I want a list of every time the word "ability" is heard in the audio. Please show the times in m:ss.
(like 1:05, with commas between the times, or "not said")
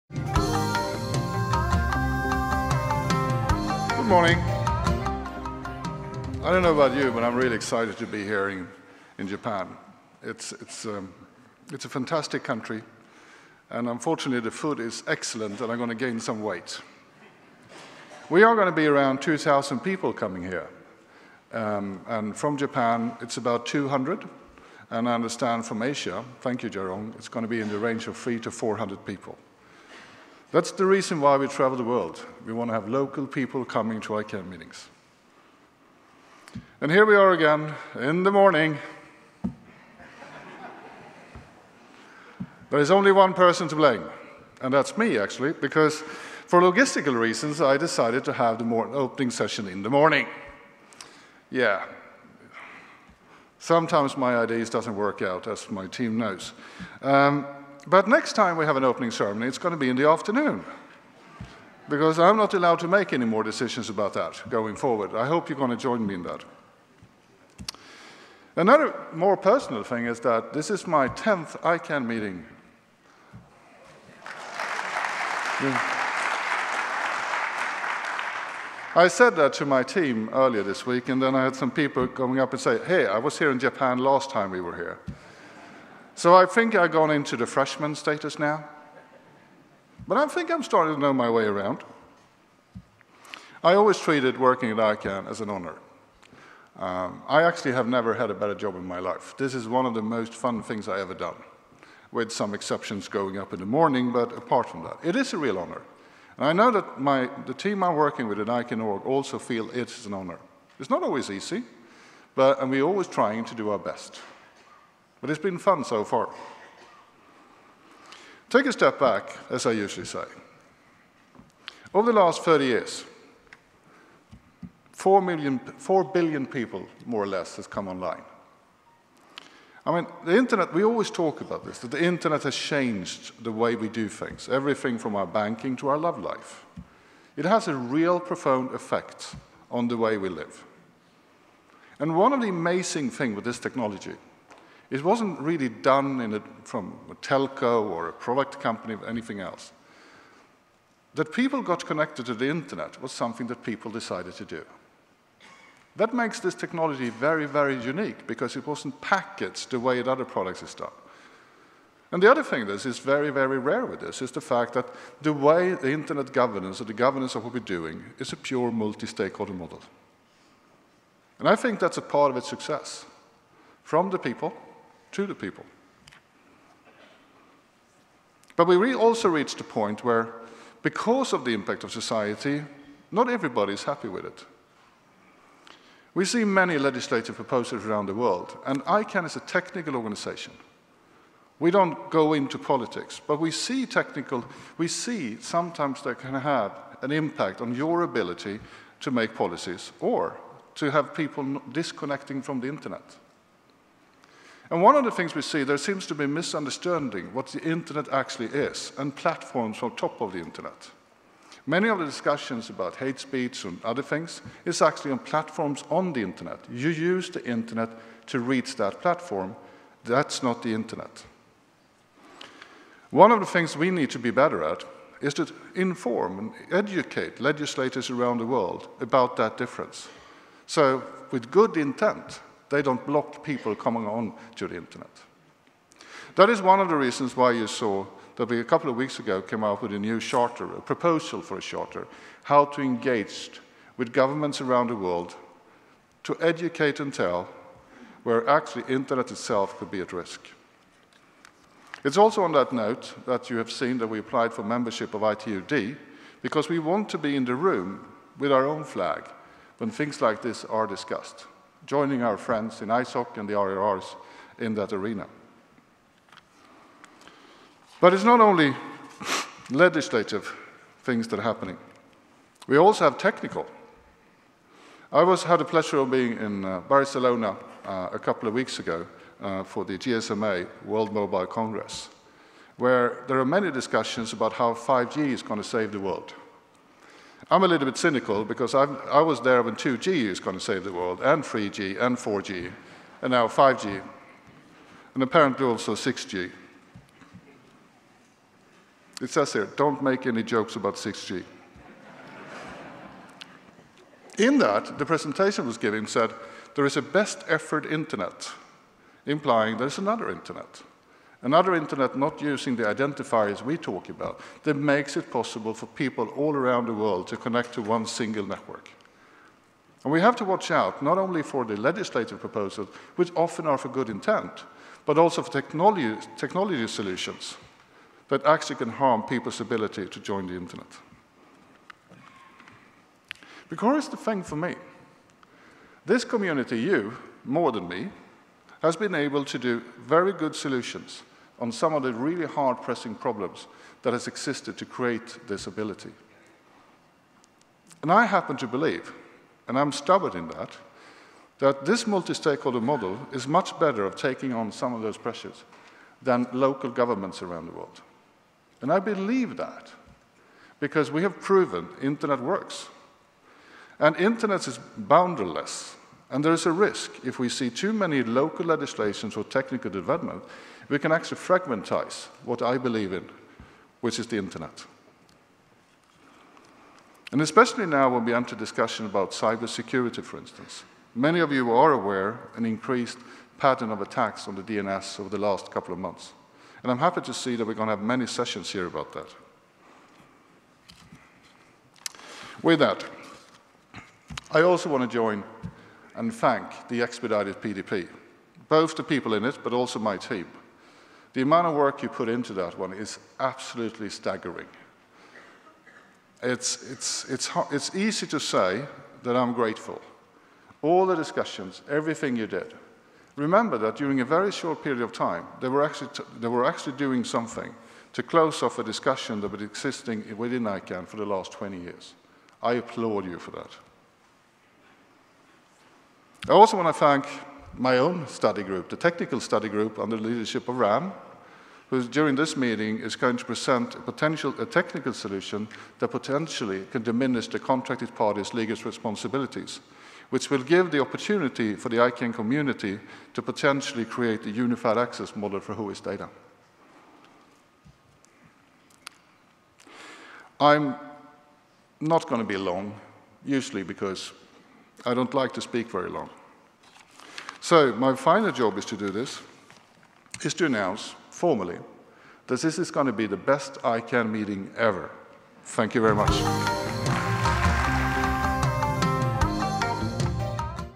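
3:18, 5:29, 5:45.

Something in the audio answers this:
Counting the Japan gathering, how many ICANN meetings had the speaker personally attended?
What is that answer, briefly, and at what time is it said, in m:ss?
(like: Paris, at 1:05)
10th, at 1:11.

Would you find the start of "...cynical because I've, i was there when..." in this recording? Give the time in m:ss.
4:47.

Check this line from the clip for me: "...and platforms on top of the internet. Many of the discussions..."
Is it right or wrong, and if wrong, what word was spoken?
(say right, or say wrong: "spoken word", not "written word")
right.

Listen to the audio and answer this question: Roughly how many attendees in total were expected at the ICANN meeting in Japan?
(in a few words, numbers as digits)
2,000.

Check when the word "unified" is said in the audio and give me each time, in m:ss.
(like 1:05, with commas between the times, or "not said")
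7:24.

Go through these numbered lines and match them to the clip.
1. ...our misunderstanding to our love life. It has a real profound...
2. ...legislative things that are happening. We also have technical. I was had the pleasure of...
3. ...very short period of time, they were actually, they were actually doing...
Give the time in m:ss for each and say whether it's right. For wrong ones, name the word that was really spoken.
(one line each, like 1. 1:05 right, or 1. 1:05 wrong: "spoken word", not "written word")
1. 2:15 wrong: "banking", not "misunderstanding"
2. 4:29 right
3. 6:54 right.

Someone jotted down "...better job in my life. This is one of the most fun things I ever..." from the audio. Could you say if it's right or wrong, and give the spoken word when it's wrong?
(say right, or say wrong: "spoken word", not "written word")
right.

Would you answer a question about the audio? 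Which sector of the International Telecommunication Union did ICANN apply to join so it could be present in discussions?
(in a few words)
ITU-D.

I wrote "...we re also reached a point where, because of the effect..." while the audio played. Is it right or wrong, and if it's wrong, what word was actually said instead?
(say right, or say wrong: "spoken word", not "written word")
wrong: "impact", not "effect".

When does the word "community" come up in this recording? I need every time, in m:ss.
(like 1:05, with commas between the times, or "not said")
5:36, 7:22.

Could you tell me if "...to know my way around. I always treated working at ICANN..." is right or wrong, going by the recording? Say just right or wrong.
right.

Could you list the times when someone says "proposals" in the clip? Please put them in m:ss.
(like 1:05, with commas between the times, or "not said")
3:07, 4:00, 5:22.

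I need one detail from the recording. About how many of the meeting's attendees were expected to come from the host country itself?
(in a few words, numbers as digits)
200.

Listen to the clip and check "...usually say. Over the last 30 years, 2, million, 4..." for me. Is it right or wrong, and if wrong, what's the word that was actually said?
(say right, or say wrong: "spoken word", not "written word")
wrong: "4", not "2".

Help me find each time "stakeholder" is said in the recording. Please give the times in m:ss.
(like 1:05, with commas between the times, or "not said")
2:48, 5:52.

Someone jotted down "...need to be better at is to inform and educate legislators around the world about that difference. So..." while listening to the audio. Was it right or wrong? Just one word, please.
right.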